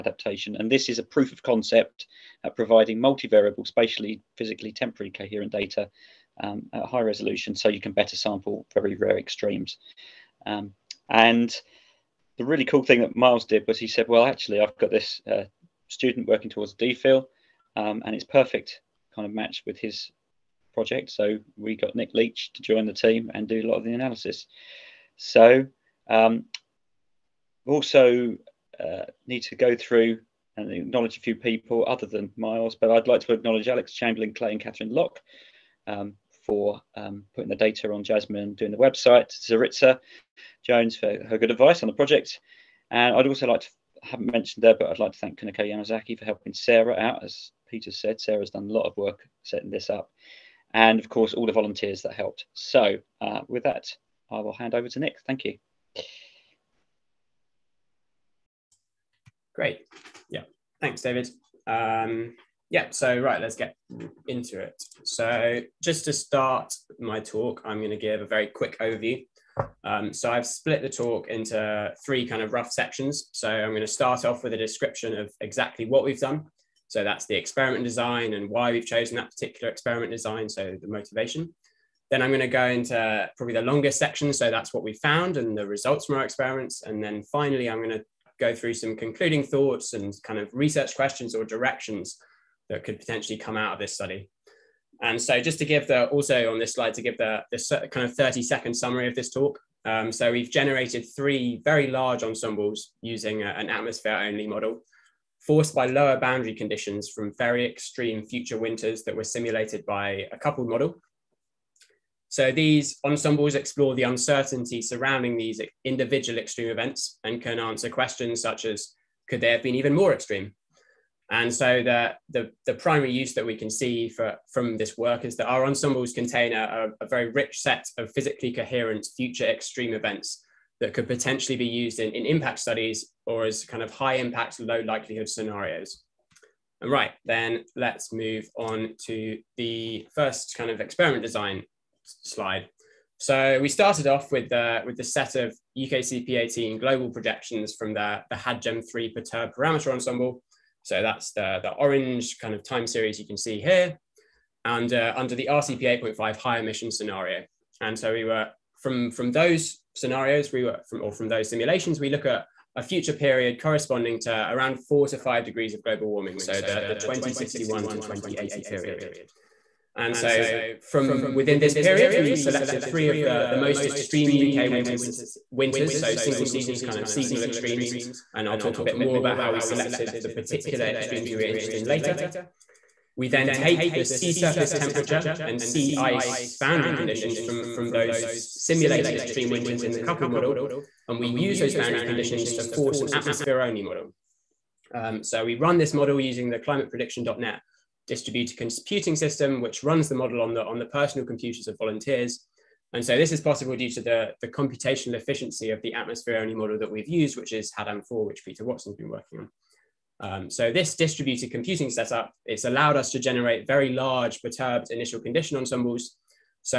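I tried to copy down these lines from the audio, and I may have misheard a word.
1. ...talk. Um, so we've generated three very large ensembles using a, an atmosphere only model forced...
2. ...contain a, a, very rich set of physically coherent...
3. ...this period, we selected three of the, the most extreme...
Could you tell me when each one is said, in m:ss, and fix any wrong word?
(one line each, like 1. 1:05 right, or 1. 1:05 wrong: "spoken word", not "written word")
1. 1:39 right
2. 2:06 right
3. 2:51 right.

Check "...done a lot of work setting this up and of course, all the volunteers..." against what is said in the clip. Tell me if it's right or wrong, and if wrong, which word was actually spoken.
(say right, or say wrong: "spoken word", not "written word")
right.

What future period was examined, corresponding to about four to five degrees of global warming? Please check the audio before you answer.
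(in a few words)
2061 to 2080.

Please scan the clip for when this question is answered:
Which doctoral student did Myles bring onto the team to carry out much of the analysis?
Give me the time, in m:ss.
0:21.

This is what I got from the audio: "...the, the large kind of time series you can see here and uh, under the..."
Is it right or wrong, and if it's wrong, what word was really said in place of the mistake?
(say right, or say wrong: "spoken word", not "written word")
wrong: "orange", not "large".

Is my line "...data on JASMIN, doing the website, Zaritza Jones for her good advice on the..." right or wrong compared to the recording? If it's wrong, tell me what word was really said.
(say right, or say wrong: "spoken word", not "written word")
right.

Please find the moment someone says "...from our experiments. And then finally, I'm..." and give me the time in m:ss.
1:26.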